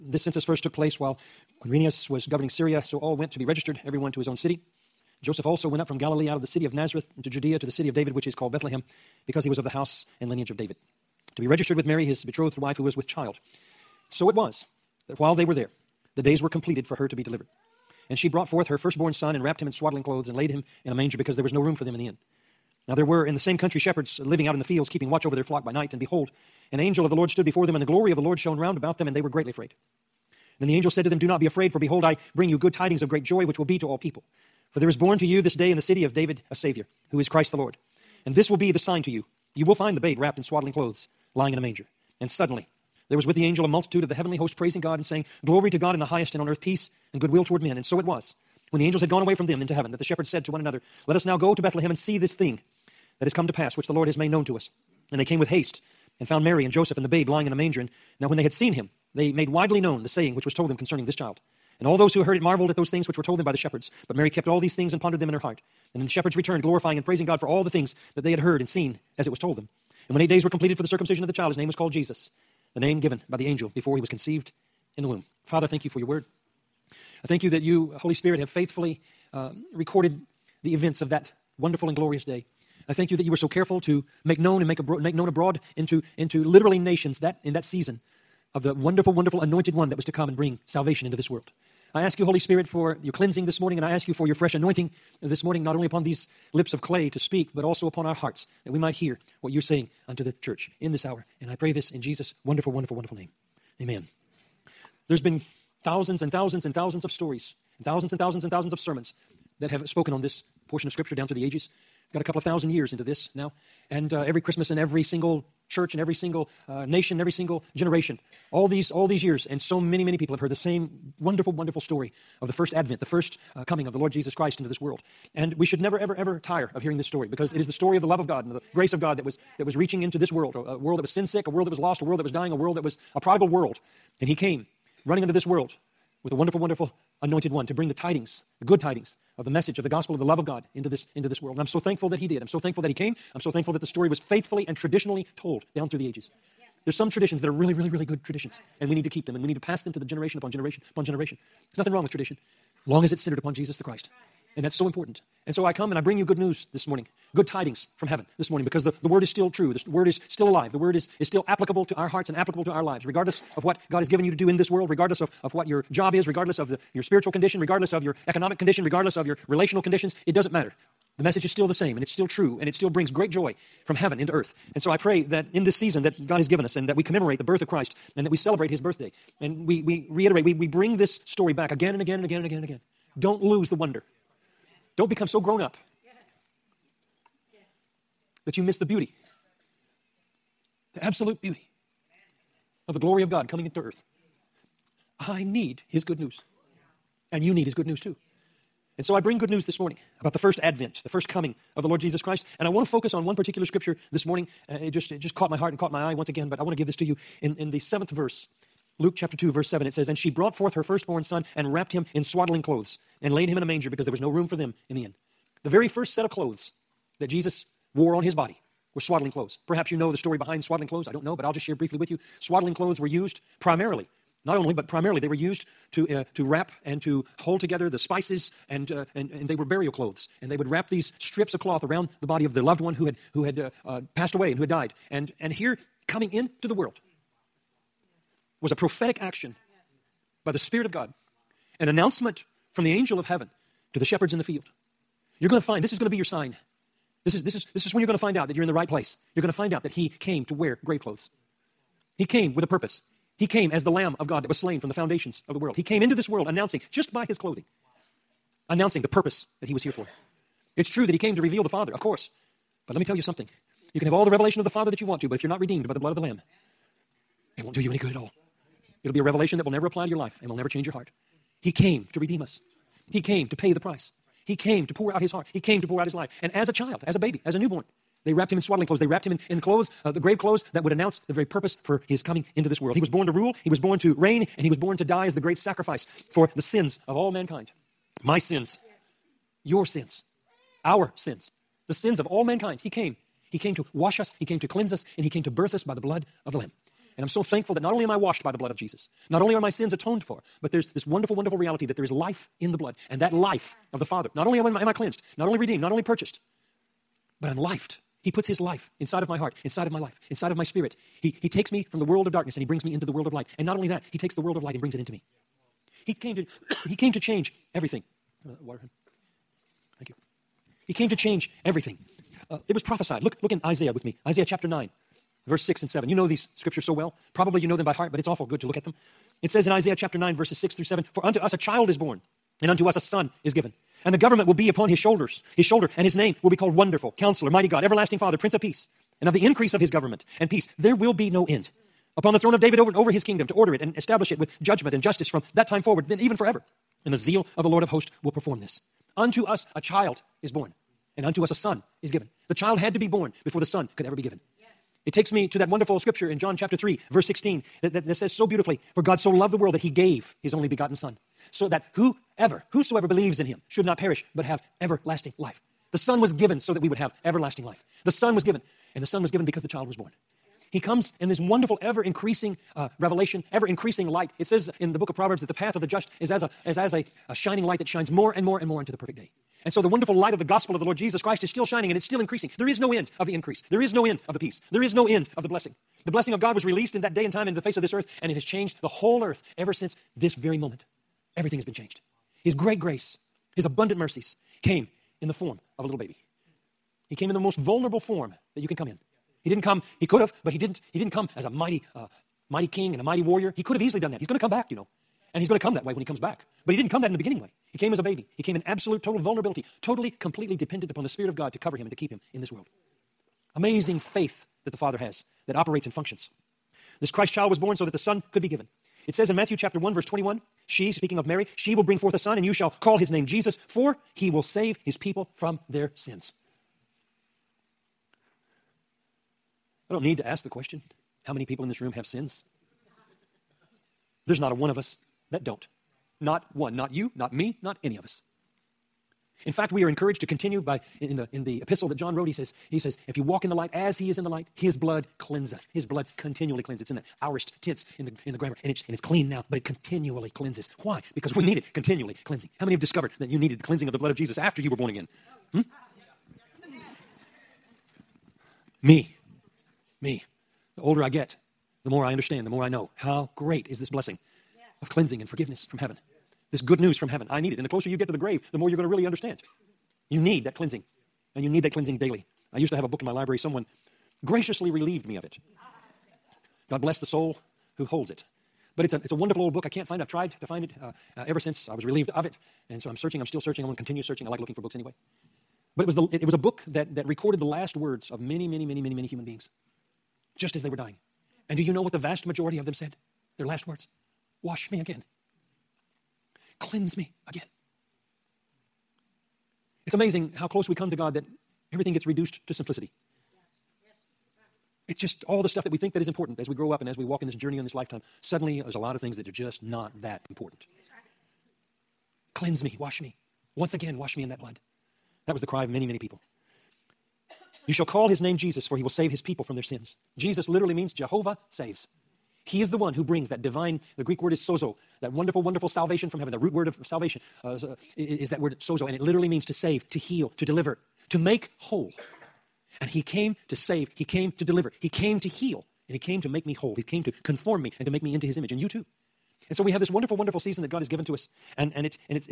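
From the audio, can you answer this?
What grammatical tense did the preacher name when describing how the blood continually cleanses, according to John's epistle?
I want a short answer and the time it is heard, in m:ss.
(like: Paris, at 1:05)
Aorist, at 7:27.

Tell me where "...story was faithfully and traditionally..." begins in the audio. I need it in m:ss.
2:23.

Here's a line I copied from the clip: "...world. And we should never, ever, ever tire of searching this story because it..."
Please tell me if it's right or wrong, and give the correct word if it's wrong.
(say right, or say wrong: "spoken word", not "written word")
wrong: "hearing", not "searching".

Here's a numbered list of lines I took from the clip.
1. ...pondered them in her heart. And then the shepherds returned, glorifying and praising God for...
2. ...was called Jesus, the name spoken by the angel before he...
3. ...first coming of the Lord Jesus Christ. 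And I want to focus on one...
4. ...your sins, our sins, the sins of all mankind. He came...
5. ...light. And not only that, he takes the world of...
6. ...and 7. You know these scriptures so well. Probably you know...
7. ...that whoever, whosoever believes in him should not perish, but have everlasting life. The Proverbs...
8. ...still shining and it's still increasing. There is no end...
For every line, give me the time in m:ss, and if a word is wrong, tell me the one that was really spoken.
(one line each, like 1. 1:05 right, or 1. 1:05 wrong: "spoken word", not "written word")
1. 1:05 right
2. 1:11 wrong: "given", not "spoken"
3. 3:21 right
4. 4:49 right
5. 5:13 right
6. 5:25 right
7. 6:01 wrong: "Son", not "Proverbs"
8. 6:21 right.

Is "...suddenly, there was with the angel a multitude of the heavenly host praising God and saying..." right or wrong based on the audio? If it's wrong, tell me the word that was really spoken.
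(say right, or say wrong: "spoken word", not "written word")
right.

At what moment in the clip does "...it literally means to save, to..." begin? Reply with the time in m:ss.
8:48.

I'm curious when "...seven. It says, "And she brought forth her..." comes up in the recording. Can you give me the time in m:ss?
3:29.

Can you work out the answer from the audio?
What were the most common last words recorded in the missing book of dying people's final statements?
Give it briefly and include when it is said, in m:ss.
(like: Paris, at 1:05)
Wash me again, at 8:14.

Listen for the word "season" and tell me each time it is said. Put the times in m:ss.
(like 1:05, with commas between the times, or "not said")
1:27, 2:55, 9:00.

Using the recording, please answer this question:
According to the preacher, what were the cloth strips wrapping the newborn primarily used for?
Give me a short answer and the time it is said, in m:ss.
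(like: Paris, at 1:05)
Burial clothes, at 3:49.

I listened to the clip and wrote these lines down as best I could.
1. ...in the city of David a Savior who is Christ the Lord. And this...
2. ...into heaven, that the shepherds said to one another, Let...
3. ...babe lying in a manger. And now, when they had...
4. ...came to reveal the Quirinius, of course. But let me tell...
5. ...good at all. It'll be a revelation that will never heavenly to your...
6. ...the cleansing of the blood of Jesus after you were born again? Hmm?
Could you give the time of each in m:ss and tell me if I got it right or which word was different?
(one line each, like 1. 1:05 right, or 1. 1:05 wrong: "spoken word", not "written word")
1. 0:35 right
2. 0:49 right
3. 0:57 right
4. 4:21 wrong: "Father", not "Quirinius"
5. 4:27 wrong: "apply", not "heavenly"
6. 7:33 right.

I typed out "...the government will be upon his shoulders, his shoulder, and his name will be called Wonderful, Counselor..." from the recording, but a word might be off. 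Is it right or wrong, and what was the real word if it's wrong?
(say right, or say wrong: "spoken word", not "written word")
right.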